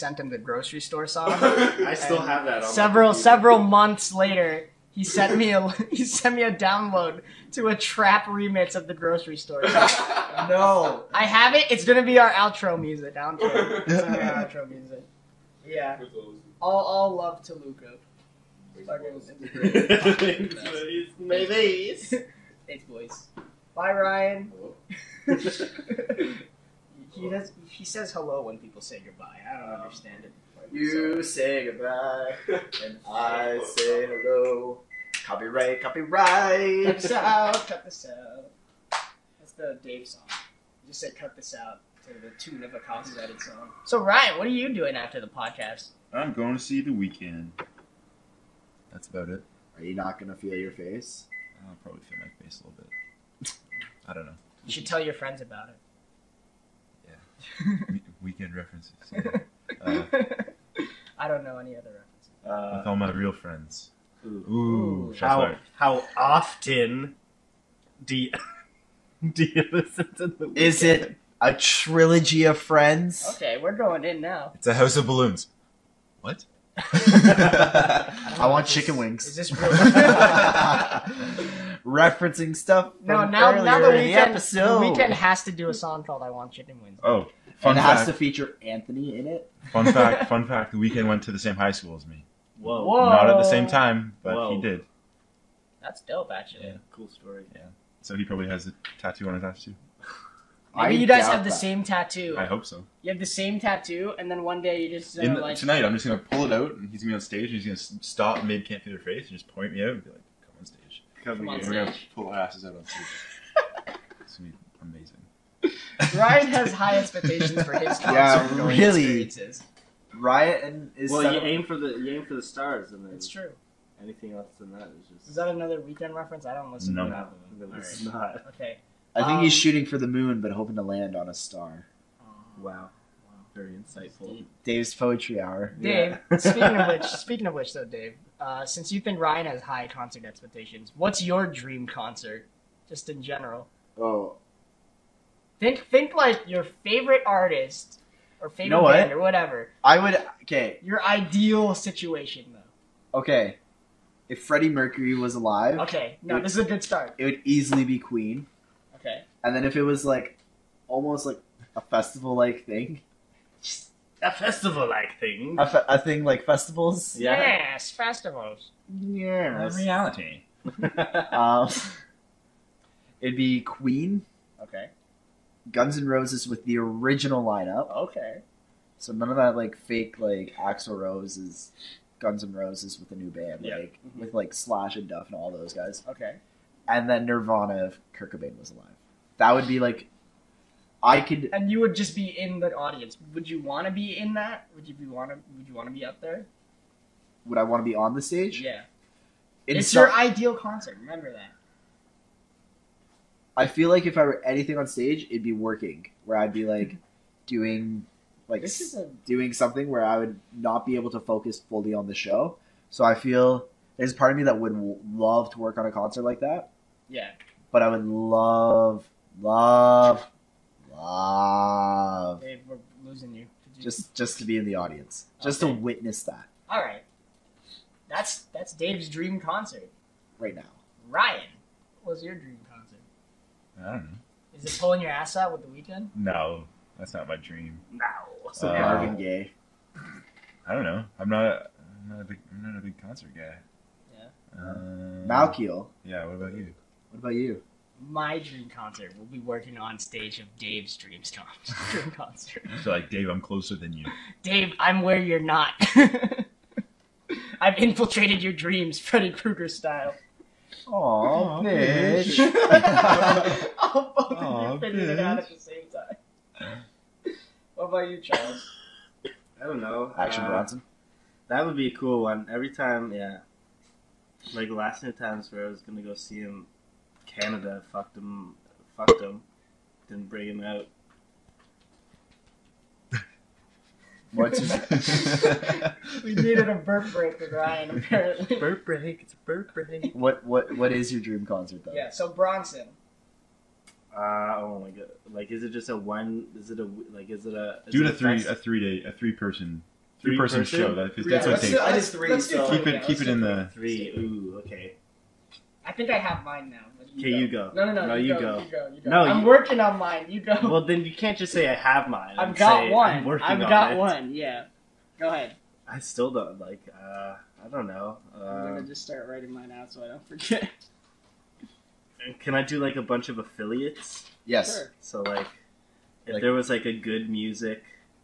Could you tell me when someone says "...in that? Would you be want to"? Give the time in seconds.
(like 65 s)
194 s.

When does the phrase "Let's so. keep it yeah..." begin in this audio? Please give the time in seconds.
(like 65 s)
302 s.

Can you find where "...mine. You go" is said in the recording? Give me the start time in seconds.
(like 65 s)
309 s.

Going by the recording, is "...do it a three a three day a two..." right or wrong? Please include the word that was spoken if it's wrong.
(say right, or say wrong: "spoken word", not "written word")
wrong: "three", not "two".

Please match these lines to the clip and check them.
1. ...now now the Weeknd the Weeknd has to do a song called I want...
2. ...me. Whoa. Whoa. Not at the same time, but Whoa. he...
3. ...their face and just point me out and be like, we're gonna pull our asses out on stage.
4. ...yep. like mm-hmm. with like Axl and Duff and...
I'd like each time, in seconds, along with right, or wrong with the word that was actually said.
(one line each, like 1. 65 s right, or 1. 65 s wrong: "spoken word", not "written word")
1. 83 s right
2. 92 s right
3. 108 s right
4. 183 s wrong: "Slash", not "Axl".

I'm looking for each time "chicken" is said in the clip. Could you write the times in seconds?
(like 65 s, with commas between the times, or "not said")
78 s, 86 s.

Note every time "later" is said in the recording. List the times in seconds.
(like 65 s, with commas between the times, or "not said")
4 s.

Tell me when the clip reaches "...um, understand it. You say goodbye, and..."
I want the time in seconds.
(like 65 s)
29 s.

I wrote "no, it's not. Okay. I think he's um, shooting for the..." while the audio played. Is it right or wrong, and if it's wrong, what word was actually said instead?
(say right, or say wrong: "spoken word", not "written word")
right.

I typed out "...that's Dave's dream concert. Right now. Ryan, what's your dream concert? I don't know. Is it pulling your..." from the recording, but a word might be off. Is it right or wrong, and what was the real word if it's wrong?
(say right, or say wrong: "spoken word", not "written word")
right.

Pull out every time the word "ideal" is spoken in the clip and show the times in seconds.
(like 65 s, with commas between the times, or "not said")
151 s, 200 s.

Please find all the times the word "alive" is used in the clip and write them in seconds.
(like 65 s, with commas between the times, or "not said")
155 s, 188 s.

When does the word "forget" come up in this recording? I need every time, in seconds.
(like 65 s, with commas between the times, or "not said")
320 s.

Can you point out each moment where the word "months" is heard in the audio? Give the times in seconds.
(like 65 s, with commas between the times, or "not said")
3 s.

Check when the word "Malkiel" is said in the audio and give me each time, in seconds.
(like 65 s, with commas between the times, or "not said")
245 s.